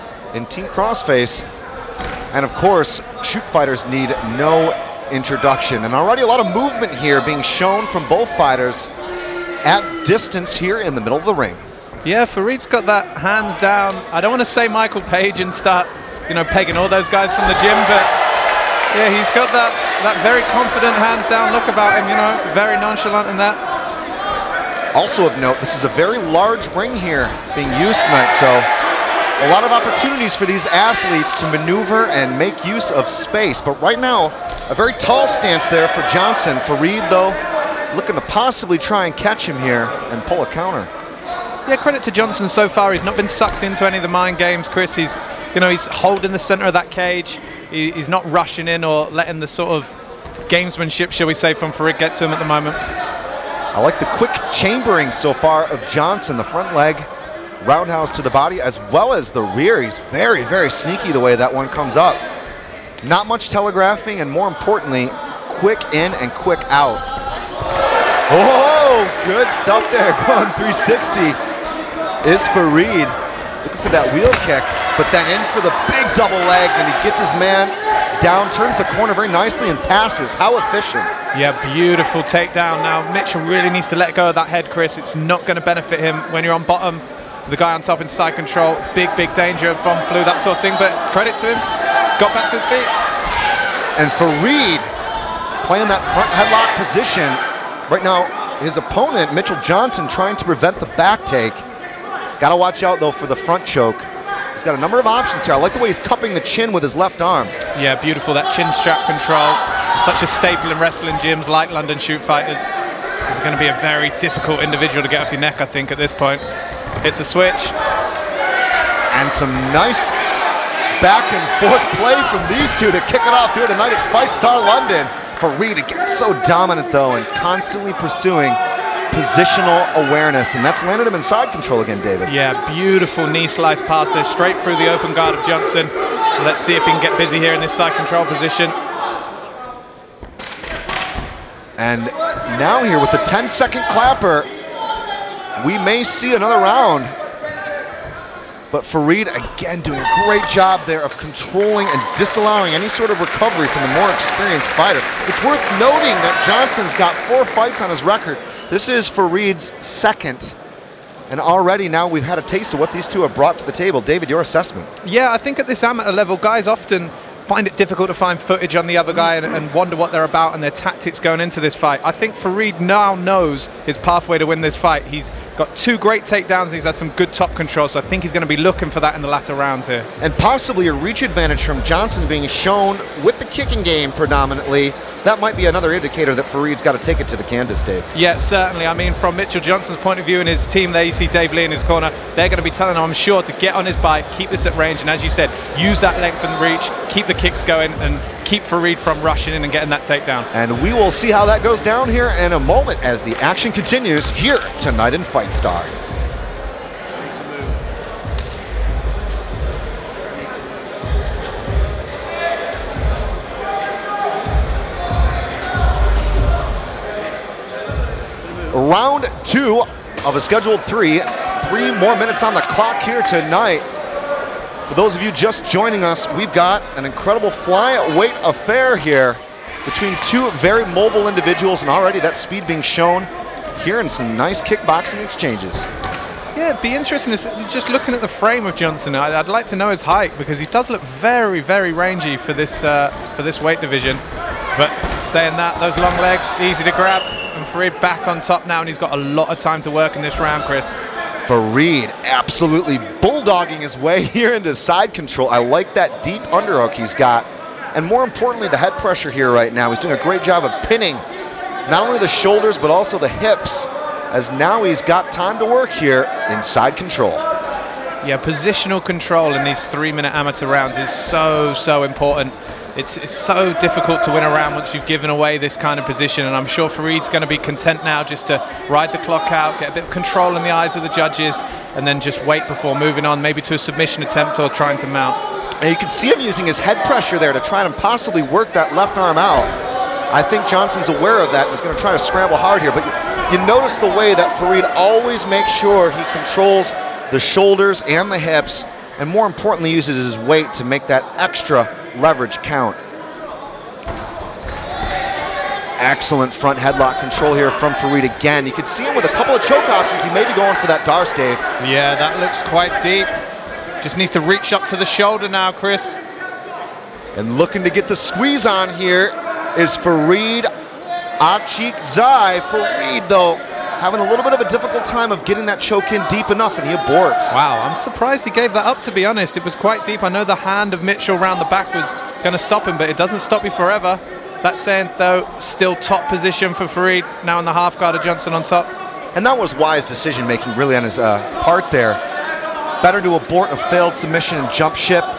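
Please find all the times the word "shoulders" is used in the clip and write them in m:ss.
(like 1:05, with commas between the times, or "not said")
4:22, 4:57, 5:15.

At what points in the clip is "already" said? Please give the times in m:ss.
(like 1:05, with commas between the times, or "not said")
0:05, 2:41, 3:51.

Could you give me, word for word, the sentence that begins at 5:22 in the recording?
Farid, though, having a little bit of a difficult time of getting that choke in deep enough, and he aborts.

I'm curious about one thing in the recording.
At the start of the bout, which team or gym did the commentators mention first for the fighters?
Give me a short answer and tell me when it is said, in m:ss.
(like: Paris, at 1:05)
Team Crossface, at 0:00.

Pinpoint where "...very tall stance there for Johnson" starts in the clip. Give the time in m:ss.
0:34.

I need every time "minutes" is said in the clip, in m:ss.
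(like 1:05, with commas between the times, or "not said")
3:42, 4:29.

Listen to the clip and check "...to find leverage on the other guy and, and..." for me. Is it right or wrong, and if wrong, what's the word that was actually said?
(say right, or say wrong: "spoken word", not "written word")
wrong: "footage", not "leverage".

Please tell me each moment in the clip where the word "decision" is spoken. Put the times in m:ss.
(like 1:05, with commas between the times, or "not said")
5:40.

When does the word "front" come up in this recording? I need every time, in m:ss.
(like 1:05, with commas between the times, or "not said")
0:56, 1:36, 1:43, 5:06.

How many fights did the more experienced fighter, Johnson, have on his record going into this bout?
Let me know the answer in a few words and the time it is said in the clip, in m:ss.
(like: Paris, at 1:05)
4, at 2:37.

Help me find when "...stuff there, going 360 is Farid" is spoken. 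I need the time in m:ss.
1:09.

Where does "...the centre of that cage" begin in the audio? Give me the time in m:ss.
0:46.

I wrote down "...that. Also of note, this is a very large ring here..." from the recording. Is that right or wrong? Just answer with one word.
right.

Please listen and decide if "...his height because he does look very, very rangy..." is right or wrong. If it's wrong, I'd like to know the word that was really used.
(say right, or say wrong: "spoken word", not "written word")
right.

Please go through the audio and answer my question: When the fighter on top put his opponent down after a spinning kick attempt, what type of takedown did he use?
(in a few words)
Double leg.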